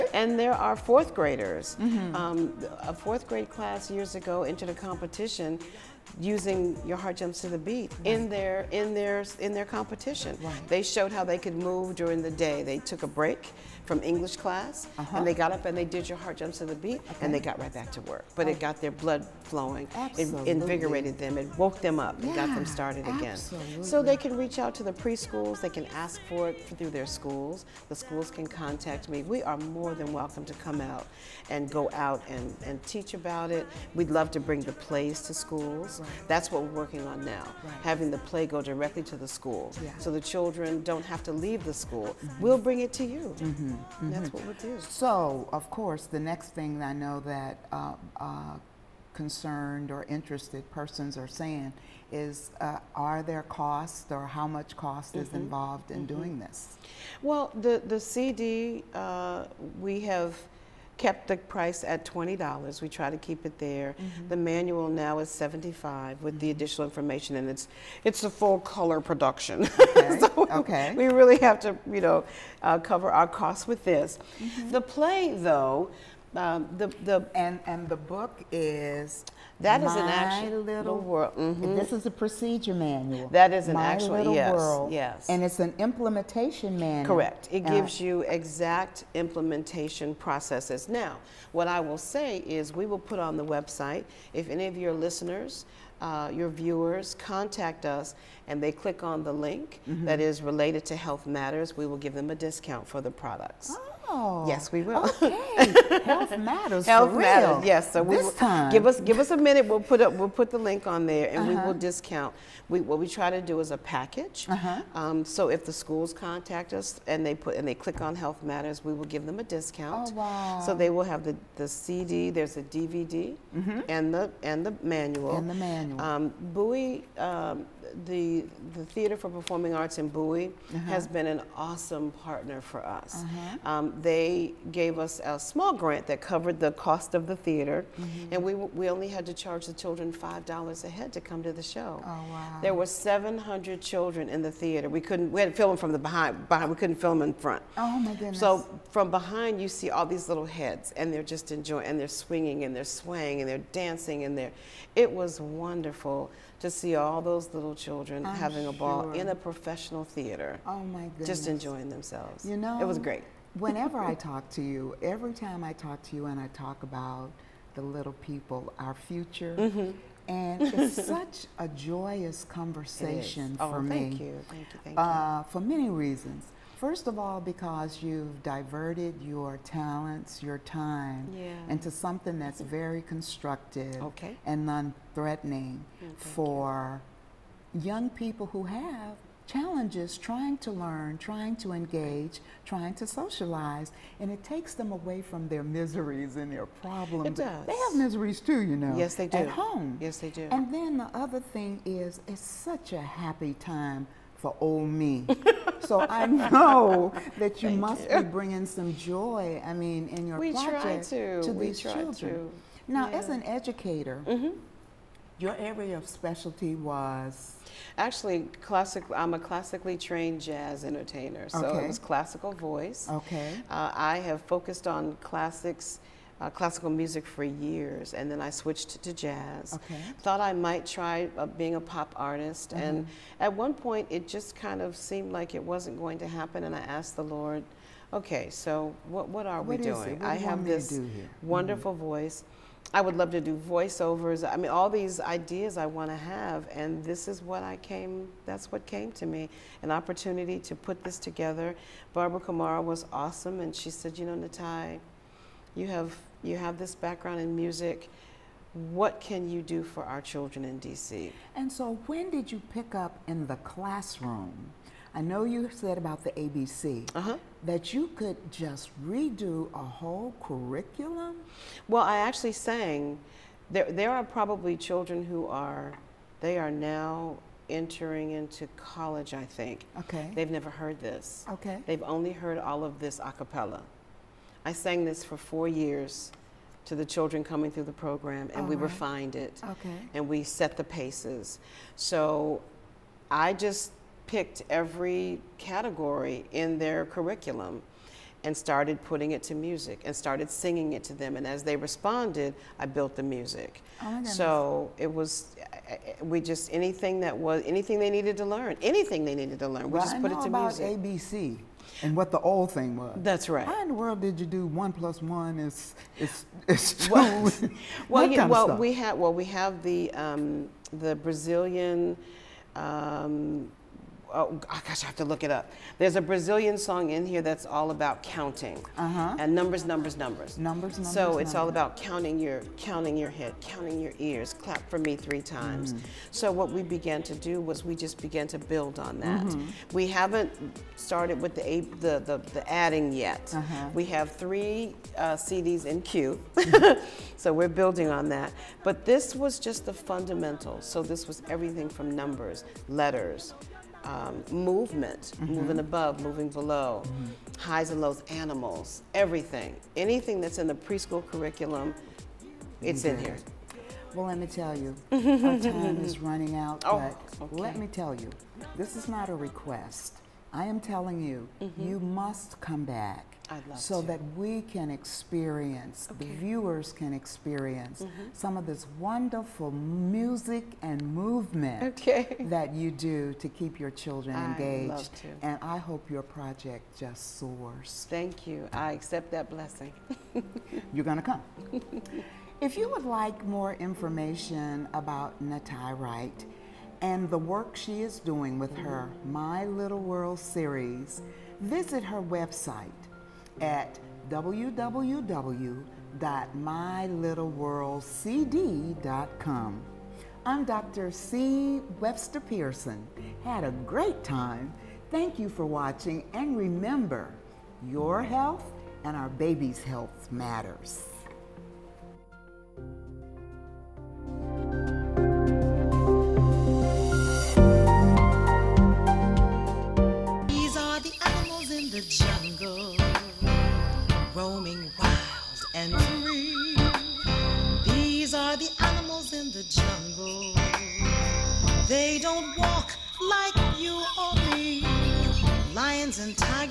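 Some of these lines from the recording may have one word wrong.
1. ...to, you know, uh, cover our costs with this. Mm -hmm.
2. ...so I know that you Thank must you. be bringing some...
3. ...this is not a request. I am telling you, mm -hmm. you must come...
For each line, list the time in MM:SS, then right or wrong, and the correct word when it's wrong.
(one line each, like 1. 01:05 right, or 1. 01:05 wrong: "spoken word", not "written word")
1. 01:11 right
2. 03:25 right
3. 06:08 right.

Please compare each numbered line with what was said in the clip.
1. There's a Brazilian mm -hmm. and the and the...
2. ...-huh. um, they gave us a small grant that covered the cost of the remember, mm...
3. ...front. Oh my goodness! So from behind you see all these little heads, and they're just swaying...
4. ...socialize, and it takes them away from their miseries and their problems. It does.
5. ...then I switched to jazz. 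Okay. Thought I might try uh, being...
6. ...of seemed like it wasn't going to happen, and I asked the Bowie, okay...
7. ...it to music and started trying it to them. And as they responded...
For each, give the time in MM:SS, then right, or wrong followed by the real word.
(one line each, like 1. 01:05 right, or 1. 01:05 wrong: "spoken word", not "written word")
1. 02:02 wrong: "DVD", not "Brazilian"
2. 02:13 wrong: "theater", not "remember"
3. 02:27 wrong: "enjoying", not "swaying"
4. 03:13 right
5. 03:48 right
6. 03:54 wrong: "Lord", not "Bowie"
7. 04:59 wrong: "singing", not "trying".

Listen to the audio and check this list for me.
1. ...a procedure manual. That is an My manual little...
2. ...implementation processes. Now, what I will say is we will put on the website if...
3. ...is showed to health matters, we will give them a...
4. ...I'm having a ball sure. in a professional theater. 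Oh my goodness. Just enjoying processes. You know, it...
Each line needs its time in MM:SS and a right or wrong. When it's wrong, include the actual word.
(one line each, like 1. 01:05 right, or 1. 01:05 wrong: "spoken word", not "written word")
1. 01:22 wrong: "actual", not "manual"
2. 01:29 right
3. 01:40 wrong: "related", not "showed"
4. 02:38 wrong: "themselves", not "processes".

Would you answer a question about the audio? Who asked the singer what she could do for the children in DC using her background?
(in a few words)
Barbara Kamara.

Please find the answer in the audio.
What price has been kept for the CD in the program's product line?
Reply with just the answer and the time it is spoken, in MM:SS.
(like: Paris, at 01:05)
$20, at 01:02.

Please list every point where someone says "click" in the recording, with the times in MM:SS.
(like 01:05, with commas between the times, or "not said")
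01:38, 01:57.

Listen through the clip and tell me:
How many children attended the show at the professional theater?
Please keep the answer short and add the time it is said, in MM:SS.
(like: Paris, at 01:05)
700, at 02:22.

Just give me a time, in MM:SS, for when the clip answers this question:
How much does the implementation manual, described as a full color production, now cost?
01:05.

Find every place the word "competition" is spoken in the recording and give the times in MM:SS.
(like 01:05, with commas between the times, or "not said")
00:04, 00:09.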